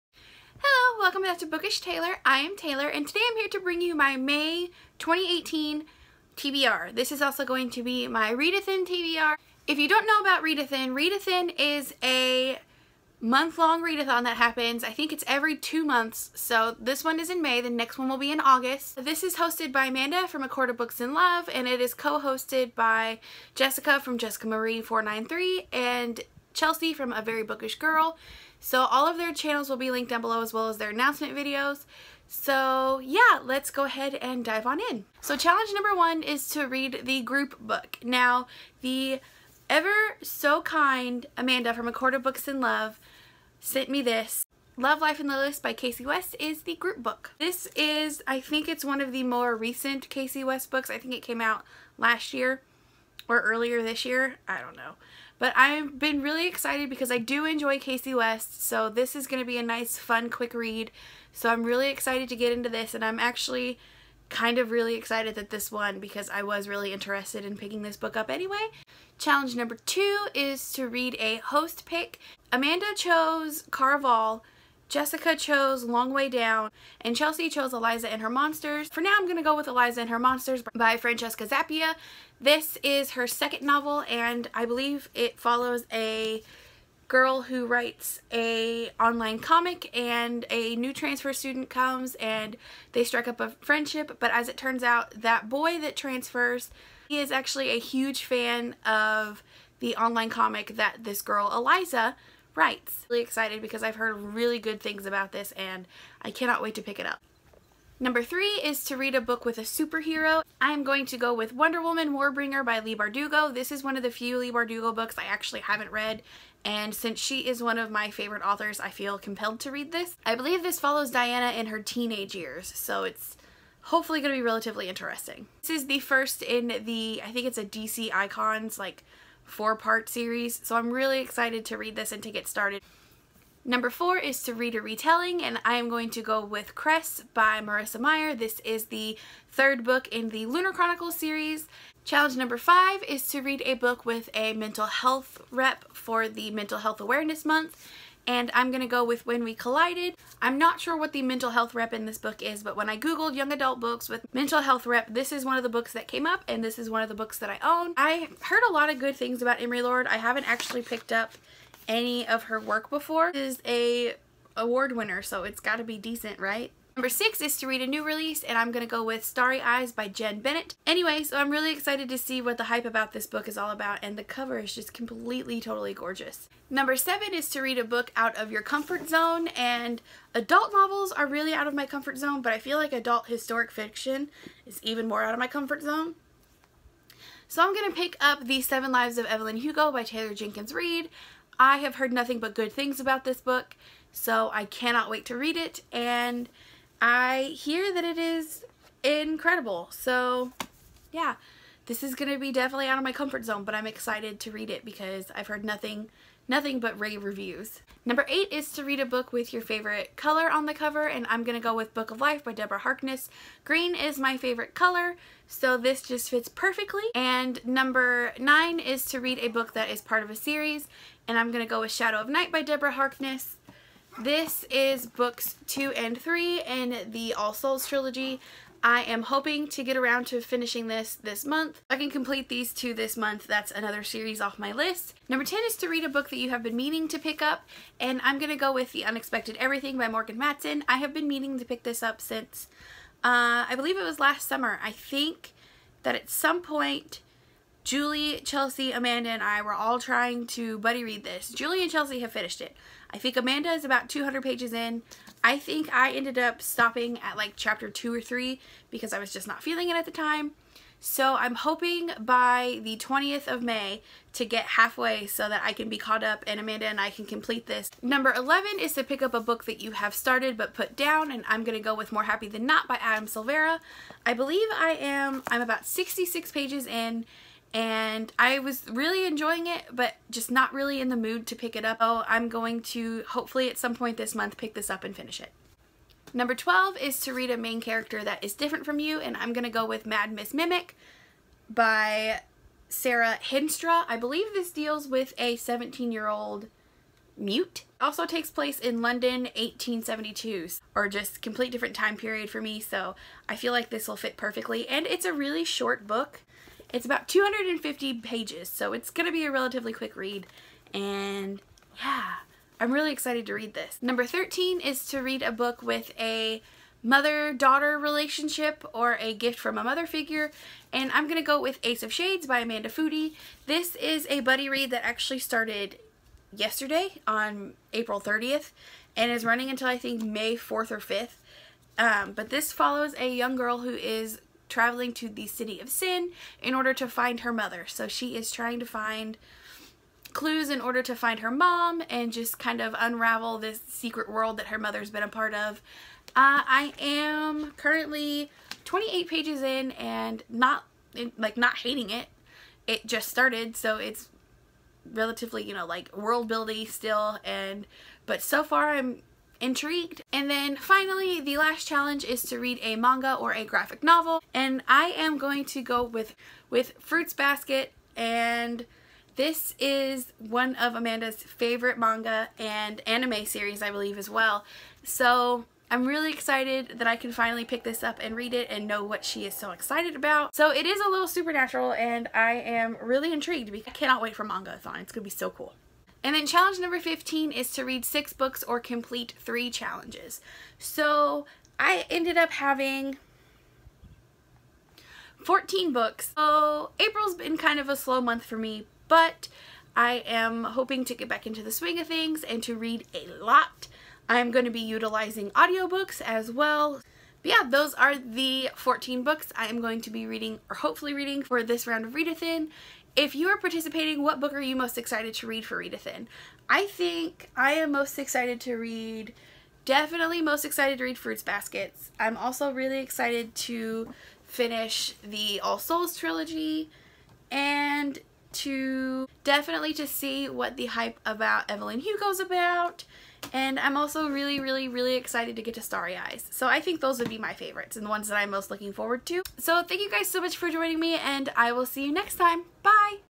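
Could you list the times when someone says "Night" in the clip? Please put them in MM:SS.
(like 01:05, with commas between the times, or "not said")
03:42.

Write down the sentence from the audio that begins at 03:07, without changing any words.
So I'm going to pick up The Seven Lives of Evelyn Hugo by Taylor Jenkins Reid.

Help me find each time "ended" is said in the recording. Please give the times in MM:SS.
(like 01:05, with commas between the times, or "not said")
04:16, 06:32.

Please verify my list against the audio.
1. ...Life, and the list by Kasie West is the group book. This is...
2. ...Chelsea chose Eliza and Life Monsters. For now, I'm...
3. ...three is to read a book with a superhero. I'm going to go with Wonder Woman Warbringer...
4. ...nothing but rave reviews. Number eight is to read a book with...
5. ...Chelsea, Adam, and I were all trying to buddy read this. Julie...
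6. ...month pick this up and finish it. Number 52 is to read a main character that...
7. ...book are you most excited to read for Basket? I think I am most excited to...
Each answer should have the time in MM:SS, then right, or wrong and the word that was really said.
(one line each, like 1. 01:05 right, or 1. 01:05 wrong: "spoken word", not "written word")
1. 00:45 right
2. 01:17 wrong: "Her", not "Life"
3. 01:48 right
4. 03:26 right
5. 04:08 wrong: "Amanda", not "Adam"
6. 04:44 wrong: "12", not "52"
7. 06:54 wrong: "Readathin", not "Basket".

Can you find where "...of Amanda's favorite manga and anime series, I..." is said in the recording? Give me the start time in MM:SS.
06:10.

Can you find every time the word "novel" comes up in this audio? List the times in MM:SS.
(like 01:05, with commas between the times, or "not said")
01:23, 03:00, 06:04.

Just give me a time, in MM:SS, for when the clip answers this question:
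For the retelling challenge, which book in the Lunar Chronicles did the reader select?
02:16.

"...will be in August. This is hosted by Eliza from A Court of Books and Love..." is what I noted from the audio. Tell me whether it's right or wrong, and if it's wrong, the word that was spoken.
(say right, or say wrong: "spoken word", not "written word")
wrong: "Amanda", not "Eliza".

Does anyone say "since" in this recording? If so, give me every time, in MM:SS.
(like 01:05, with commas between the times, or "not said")
01:56, 04:02.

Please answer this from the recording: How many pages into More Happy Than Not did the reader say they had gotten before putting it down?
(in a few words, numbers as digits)
66.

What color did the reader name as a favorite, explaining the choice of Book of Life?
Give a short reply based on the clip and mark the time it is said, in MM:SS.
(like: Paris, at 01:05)
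Green, at 03:33.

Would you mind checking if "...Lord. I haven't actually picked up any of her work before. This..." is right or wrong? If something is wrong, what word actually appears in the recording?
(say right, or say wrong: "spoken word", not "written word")
right.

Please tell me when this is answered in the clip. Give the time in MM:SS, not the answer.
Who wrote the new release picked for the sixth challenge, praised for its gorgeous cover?
02:50.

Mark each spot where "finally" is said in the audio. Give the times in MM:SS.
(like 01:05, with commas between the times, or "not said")
06:00, 06:17.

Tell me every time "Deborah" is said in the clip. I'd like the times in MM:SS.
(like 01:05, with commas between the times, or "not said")
03:32, 03:42.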